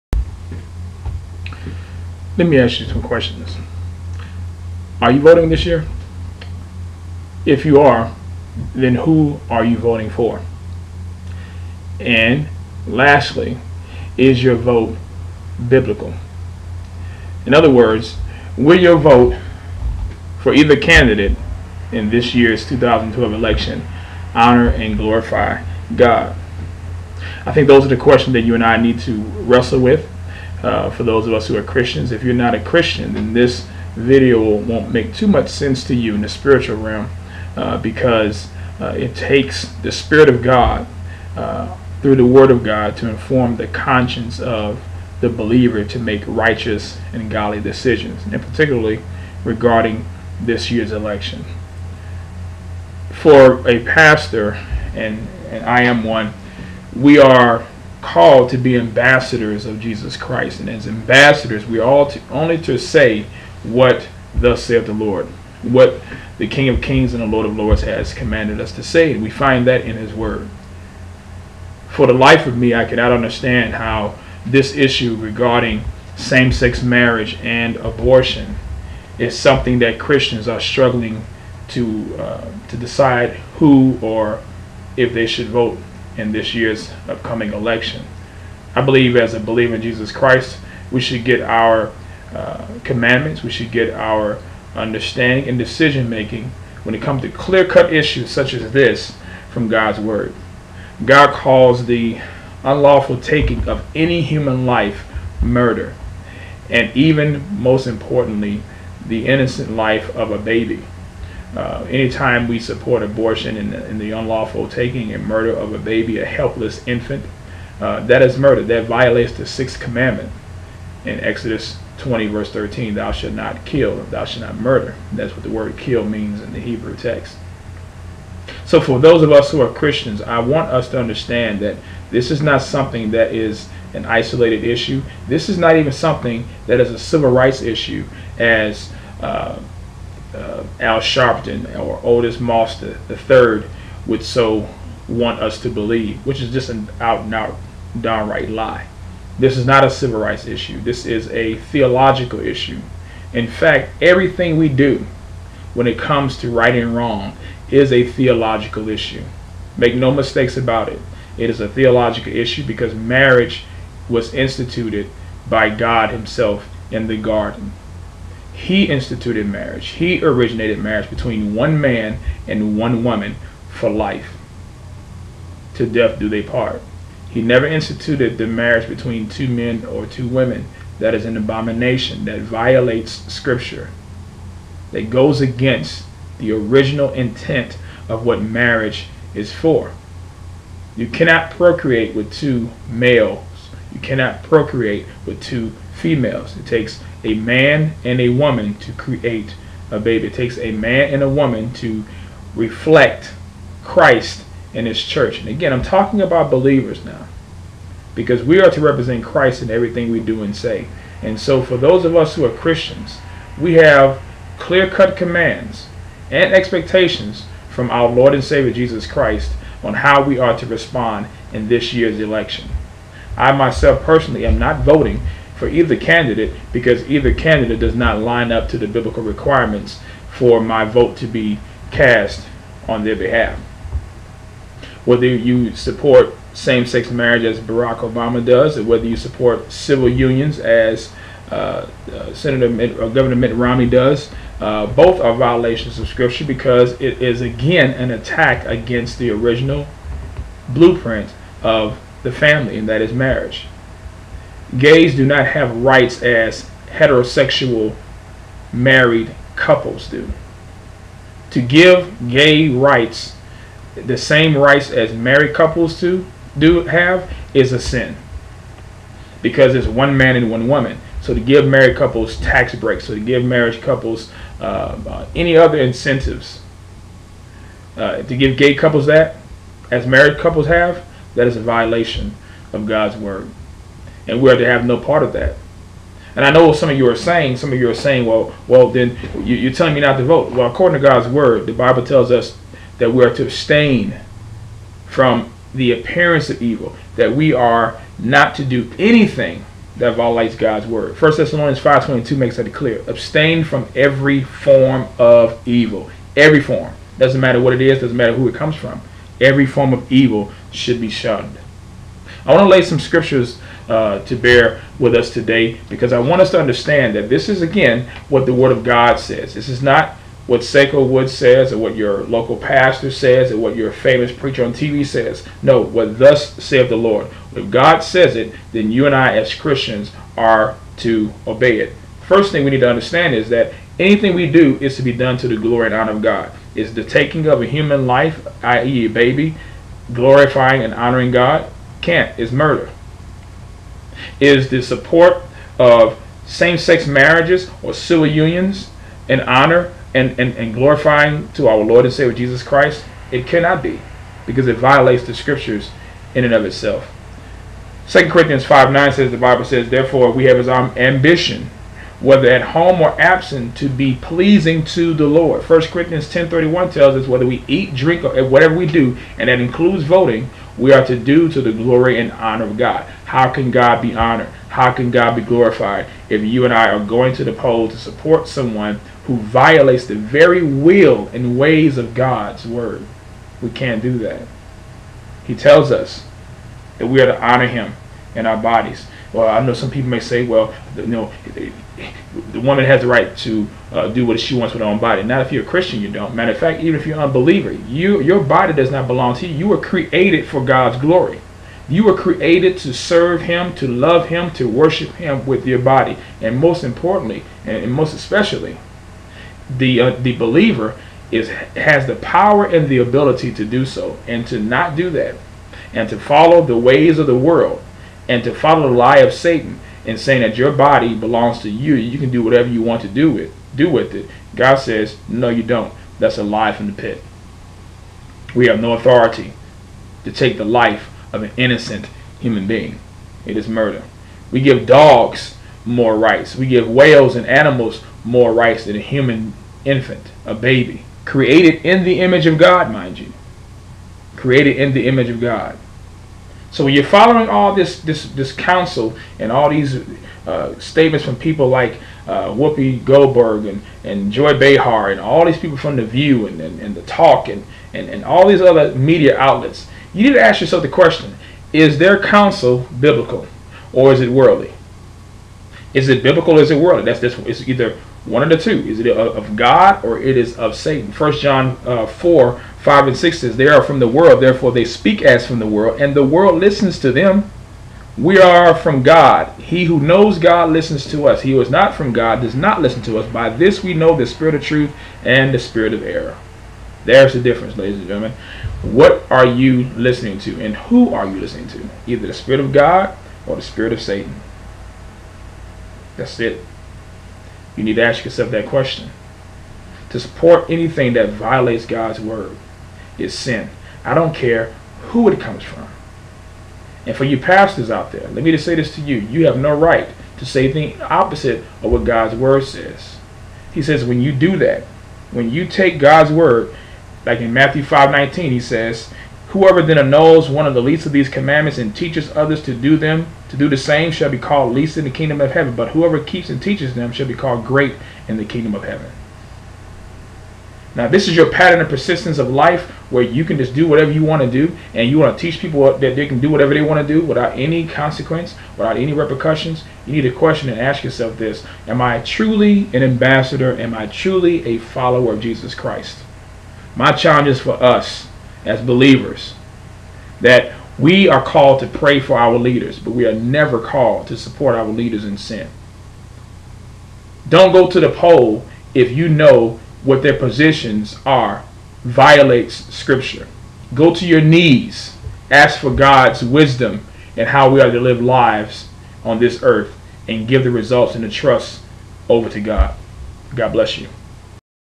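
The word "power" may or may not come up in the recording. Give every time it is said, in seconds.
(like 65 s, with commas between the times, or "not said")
412 s.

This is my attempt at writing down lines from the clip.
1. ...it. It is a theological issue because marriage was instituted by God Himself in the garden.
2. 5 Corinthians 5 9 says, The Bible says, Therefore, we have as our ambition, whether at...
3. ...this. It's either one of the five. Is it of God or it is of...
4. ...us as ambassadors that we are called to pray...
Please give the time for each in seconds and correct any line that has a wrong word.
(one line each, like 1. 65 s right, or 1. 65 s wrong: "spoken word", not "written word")
1. 160 s right
2. 358 s wrong: "2", not "5"
3. 467 s wrong: "two", not "five"
4. 547 s wrong: "believers", not "ambassadors".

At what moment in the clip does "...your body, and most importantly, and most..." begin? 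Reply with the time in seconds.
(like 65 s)
405 s.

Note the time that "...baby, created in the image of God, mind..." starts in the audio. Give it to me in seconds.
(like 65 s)
440 s.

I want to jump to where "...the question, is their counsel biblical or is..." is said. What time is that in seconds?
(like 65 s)
460 s.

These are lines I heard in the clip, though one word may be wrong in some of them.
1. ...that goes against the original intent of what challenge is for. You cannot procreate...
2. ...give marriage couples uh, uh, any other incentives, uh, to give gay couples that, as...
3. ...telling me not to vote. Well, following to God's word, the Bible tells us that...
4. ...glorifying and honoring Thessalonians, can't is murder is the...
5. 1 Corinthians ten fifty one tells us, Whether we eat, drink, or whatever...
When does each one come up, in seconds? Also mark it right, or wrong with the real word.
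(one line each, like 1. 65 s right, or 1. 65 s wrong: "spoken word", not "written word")
1. 184 s wrong: "marriage", not "challenge"
2. 273 s right
3. 289 s wrong: "according", not "following"
4. 340 s wrong: "God", not "Thessalonians"
5. 365 s wrong: "thirty", not "fifty".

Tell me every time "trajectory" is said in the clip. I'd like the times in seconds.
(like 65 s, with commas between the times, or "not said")
not said.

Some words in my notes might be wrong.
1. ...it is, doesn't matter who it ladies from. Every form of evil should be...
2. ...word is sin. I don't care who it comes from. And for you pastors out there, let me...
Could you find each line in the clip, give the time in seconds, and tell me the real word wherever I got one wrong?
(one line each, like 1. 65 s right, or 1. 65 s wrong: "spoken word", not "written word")
1. 307 s wrong: "comes", not "ladies"
2. 502 s right.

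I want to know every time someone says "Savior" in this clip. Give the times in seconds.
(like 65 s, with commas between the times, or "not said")
218 s, 352 s.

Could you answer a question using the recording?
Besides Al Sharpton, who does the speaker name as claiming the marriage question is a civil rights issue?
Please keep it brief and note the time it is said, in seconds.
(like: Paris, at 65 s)
Otis Moss the third, at 142 s.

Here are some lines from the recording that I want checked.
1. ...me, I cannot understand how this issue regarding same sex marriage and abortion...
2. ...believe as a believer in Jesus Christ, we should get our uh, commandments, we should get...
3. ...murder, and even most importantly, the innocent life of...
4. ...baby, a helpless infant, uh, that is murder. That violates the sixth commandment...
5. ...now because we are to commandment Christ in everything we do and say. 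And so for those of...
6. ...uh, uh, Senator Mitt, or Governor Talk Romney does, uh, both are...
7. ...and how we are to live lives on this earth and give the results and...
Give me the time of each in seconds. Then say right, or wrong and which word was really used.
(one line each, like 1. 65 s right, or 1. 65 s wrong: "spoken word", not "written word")
1. 72 s right
2. 88 s right
3. 105 s right
4. 115 s right
5. 207 s wrong: "represent", not "commandment"
6. 241 s wrong: "Mitt", not "Talk"
7. 567 s right.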